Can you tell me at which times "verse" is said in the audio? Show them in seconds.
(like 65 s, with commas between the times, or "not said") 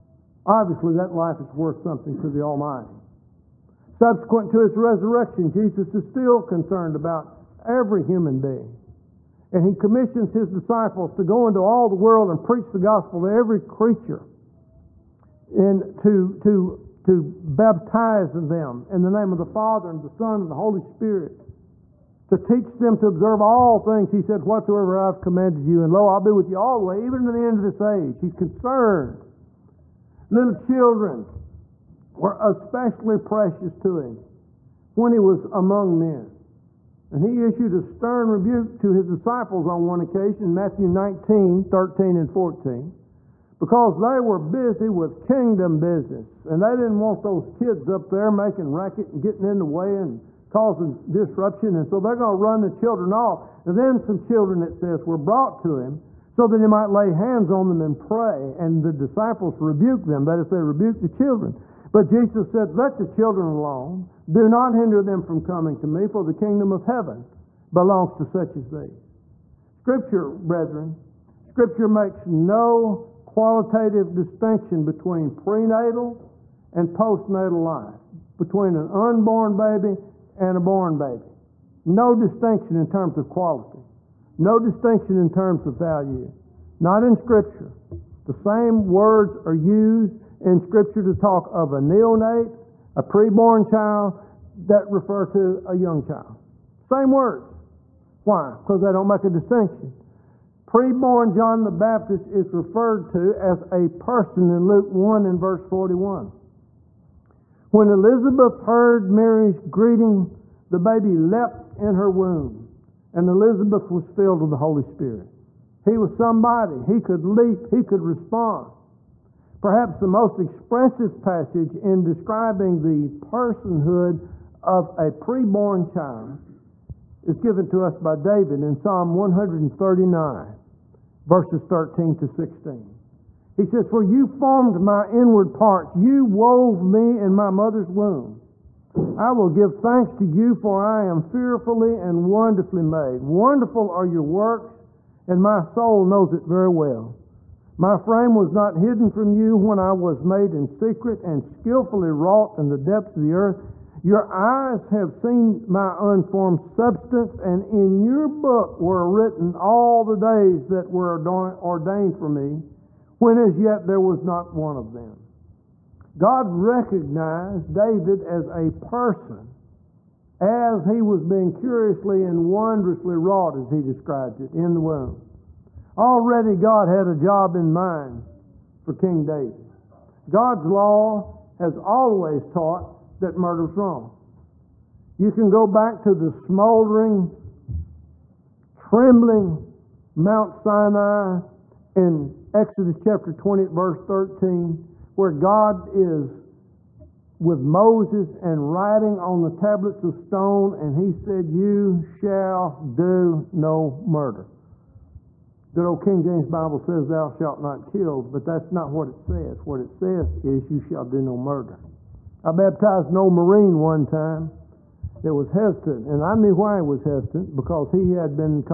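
105 s, 131 s, 193 s.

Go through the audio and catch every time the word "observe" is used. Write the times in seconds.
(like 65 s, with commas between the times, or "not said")
23 s.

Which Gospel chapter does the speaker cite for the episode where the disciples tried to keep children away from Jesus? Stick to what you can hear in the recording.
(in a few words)
Matthew 19.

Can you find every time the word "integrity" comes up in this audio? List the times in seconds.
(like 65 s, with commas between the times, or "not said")
not said.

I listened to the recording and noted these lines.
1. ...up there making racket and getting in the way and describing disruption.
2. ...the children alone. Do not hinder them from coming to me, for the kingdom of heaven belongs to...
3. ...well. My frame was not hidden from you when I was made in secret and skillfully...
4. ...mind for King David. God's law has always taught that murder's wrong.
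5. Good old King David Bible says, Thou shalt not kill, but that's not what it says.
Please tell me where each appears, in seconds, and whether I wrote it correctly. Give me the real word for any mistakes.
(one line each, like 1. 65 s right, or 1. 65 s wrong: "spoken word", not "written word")
1. 47 s wrong: "causing", not "describing"
2. 62 s right
3. 146 s right
4. 177 s right
5. 205 s wrong: "James", not "David".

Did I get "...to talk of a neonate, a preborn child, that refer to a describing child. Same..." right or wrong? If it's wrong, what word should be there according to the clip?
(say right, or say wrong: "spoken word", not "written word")
wrong: "young", not "describing".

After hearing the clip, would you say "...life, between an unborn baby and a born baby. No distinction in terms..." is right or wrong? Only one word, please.
right.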